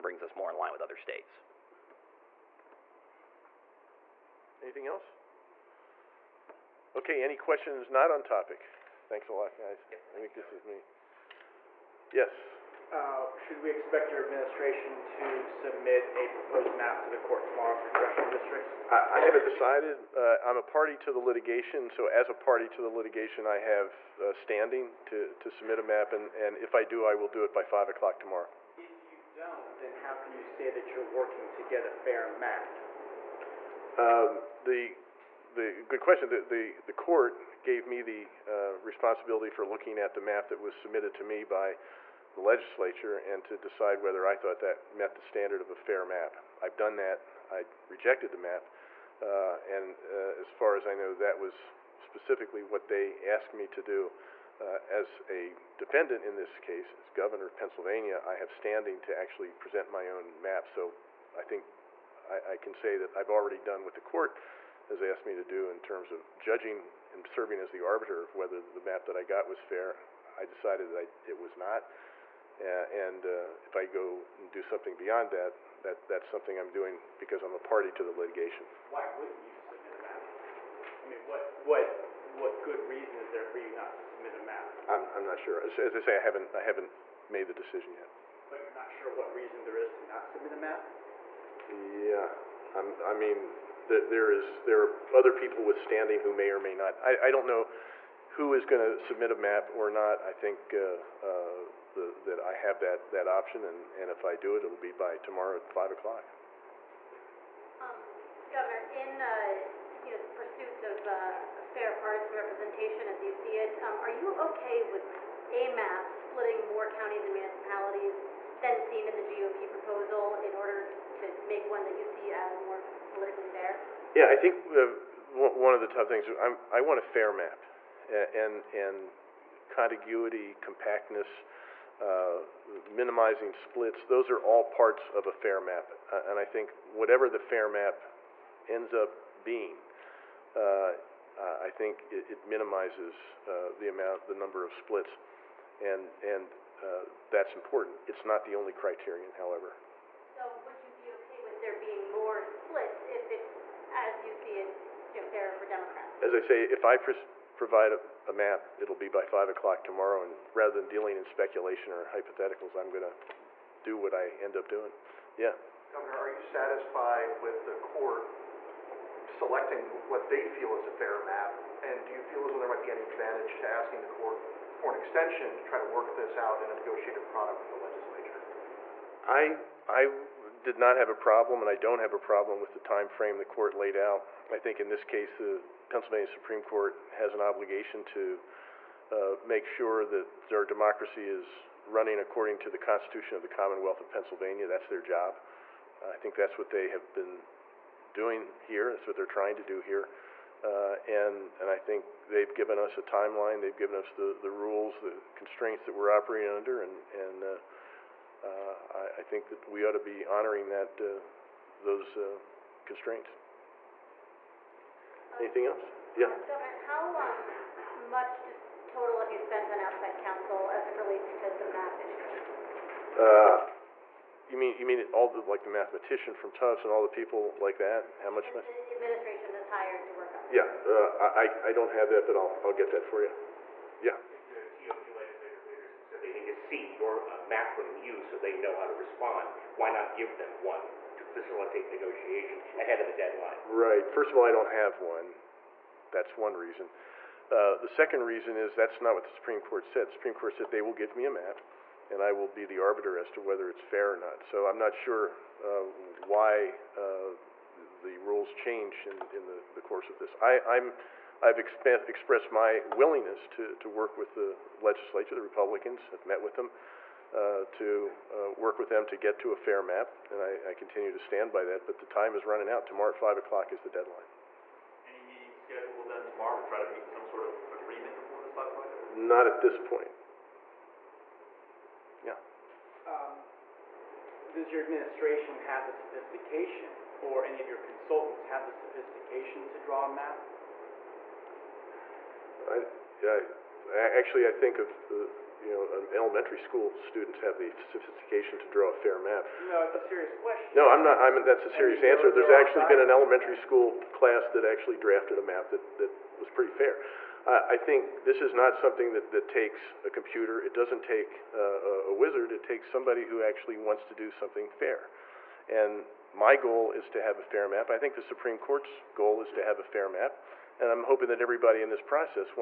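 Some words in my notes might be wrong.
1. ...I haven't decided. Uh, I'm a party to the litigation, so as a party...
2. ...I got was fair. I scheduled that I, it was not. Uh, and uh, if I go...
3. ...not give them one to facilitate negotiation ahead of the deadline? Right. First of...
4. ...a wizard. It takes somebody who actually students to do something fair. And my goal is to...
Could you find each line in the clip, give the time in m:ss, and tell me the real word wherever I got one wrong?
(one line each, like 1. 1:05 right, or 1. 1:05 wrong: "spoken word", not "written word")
1. 0:19 right
2. 1:09 wrong: "decided", not "scheduled"
3. 3:59 right
4. 5:12 wrong: "wants", not "students".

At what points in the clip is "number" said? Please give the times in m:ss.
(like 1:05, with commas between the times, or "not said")
2:24.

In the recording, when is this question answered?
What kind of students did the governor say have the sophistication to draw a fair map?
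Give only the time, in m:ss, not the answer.
4:56.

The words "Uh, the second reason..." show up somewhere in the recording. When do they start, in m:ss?
4:07.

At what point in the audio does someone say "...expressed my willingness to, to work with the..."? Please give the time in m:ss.
4:22.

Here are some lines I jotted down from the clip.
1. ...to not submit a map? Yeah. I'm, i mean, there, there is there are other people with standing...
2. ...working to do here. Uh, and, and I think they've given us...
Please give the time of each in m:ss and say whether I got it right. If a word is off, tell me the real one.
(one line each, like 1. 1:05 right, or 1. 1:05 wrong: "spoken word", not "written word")
1. 1:29 right
2. 3:19 wrong: "trying", not "working".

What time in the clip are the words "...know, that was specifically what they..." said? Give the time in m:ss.
0:50.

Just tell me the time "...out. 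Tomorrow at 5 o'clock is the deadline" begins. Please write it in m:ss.
4:32.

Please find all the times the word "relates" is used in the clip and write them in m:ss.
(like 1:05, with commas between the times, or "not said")
3:40.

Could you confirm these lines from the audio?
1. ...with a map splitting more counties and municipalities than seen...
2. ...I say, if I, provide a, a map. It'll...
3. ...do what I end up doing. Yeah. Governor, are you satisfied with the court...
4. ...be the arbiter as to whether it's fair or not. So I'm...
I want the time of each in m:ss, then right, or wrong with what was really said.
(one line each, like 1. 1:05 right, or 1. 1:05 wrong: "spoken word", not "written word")
1. 1:54 right
2. 2:36 right
3. 2:43 right
4. 4:12 right.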